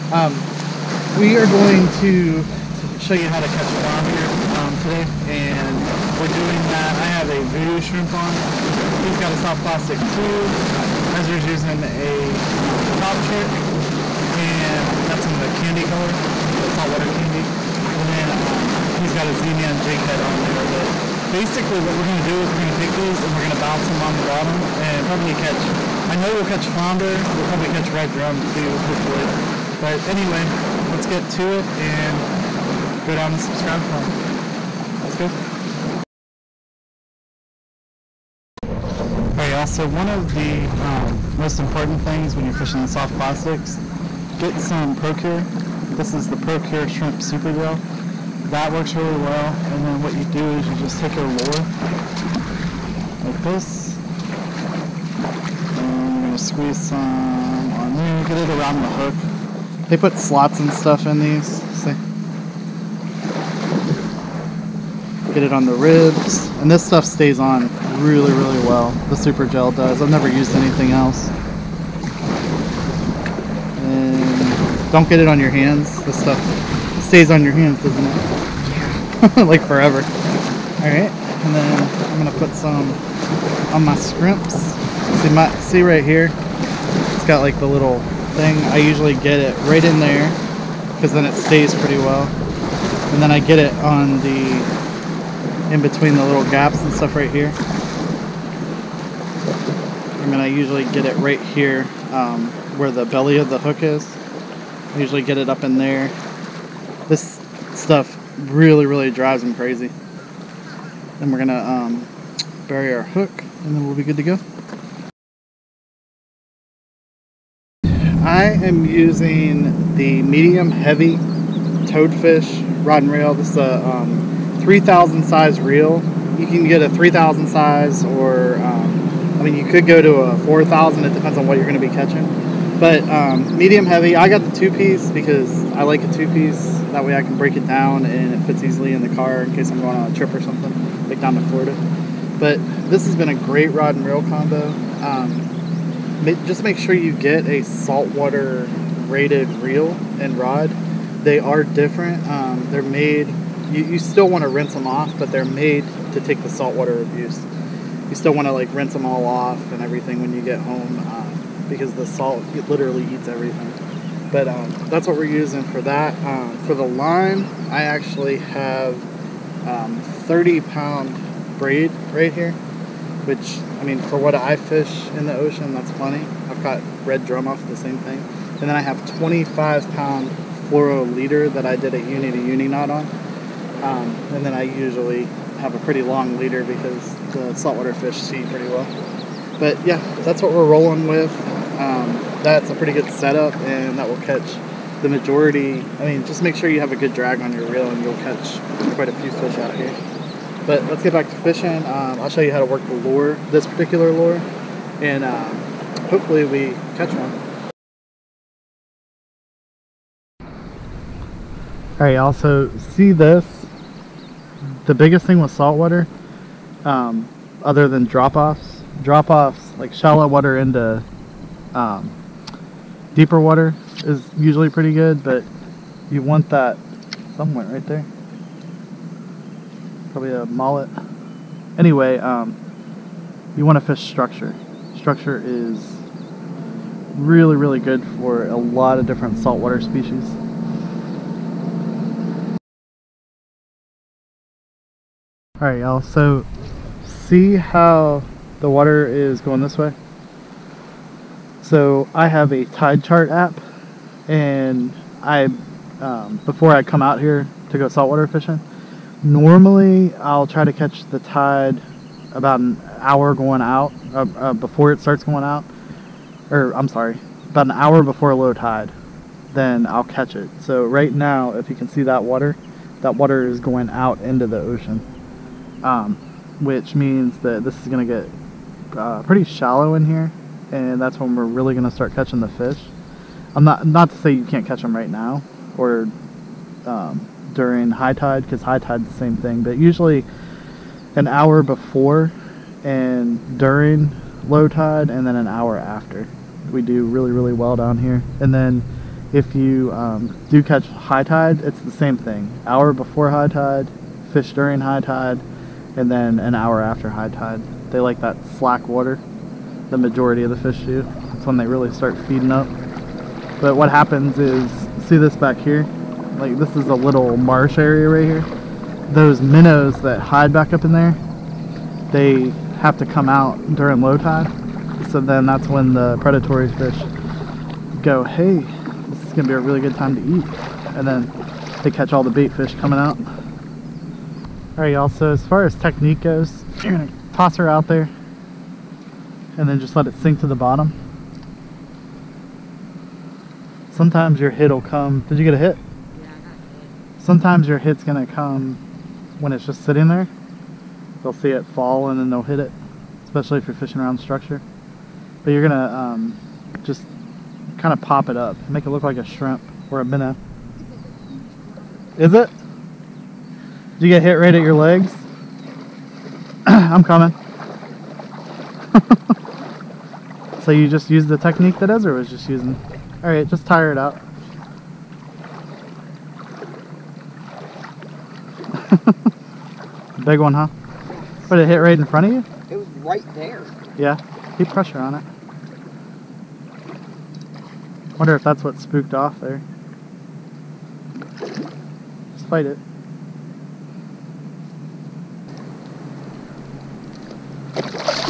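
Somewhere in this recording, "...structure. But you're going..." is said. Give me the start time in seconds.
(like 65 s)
354 s.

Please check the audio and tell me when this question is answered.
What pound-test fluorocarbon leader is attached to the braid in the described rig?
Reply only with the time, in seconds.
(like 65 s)
179 s.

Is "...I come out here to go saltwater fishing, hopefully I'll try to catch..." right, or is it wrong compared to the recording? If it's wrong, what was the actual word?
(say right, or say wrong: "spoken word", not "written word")
wrong: "normally", not "hopefully".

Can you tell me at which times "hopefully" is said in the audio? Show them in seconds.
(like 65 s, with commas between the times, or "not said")
28 s, 206 s.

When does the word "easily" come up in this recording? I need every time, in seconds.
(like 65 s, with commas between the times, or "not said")
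138 s.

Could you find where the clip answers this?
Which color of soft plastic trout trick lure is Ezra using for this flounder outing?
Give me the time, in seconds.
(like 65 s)
16 s.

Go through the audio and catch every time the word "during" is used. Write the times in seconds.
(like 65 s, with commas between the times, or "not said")
287 s, 293 s, 304 s, 323 s.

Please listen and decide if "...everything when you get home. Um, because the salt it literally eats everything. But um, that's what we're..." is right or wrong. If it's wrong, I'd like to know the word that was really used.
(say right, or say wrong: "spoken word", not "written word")
right.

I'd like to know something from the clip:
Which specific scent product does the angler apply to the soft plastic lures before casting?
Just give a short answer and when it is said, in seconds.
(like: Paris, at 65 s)
Procure Shrimp Super Gel, at 46 s.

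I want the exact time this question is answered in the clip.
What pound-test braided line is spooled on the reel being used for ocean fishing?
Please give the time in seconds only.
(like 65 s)
169 s.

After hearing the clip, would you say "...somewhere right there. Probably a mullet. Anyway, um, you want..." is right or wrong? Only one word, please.
right.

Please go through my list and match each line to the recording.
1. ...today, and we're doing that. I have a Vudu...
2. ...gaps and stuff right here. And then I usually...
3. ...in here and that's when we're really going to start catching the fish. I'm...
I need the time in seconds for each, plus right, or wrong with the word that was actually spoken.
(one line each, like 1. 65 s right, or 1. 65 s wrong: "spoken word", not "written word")
1. 4 s right
2. 96 s right
3. 279 s right.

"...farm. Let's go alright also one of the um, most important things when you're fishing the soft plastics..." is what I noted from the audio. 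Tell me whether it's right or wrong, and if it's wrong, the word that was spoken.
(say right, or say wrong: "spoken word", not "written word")
right.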